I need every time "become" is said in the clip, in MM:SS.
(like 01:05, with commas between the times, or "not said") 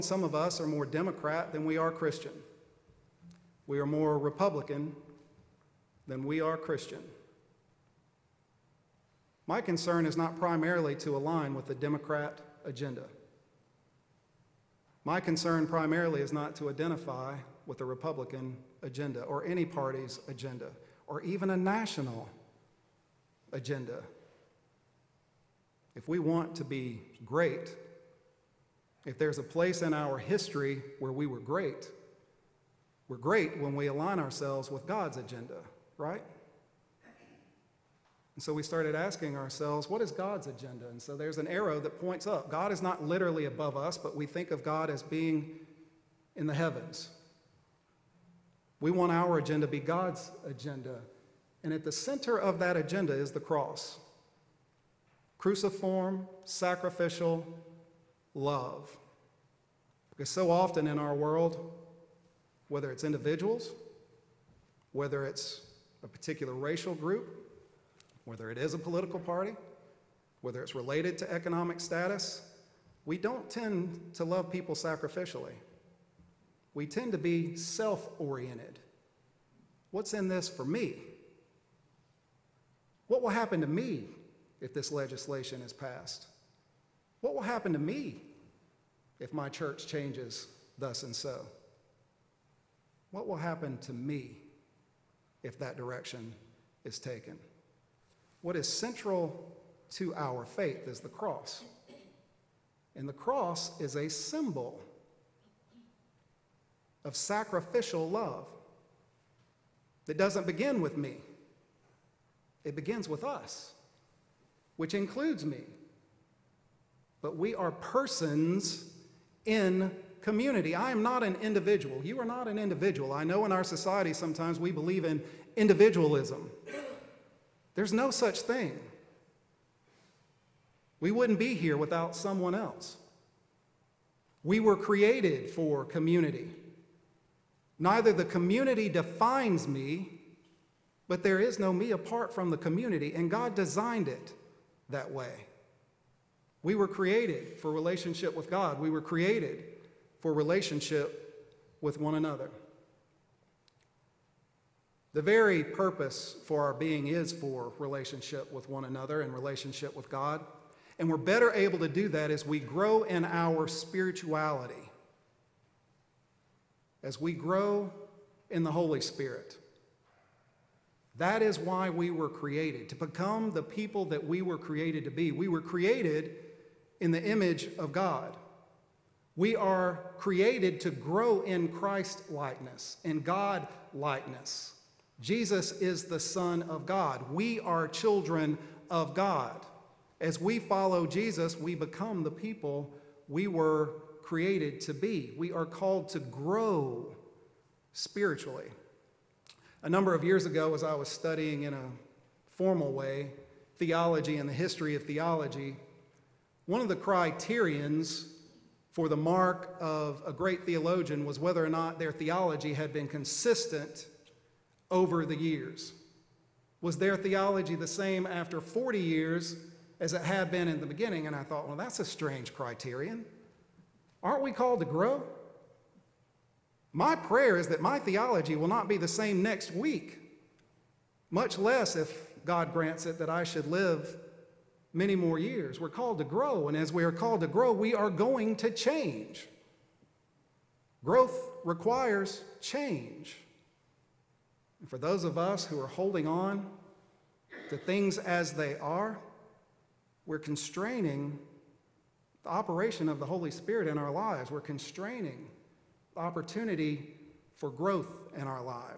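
02:52, 03:11.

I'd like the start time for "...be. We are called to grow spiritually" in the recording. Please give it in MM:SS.
03:14.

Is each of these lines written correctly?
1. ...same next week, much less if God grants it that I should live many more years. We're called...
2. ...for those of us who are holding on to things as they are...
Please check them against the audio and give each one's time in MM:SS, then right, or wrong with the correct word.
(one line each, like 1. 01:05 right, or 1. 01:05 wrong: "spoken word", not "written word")
1. 03:49 right
2. 04:04 right.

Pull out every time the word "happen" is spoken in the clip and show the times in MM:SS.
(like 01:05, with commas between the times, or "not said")
01:23, 01:27, 01:33.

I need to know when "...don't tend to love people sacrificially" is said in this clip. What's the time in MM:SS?
01:13.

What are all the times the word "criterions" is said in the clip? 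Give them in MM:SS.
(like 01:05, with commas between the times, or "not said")
03:26, 03:42.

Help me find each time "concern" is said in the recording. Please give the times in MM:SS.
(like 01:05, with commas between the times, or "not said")
00:09, 00:15.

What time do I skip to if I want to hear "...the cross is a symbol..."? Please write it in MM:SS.
01:43.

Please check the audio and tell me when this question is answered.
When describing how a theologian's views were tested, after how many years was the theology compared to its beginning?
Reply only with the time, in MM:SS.
03:38.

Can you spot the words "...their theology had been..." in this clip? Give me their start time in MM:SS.
03:32.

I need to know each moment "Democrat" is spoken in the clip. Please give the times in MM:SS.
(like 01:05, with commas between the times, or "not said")
00:00, 00:11.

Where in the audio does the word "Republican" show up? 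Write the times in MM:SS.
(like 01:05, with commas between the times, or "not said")
00:04, 00:17.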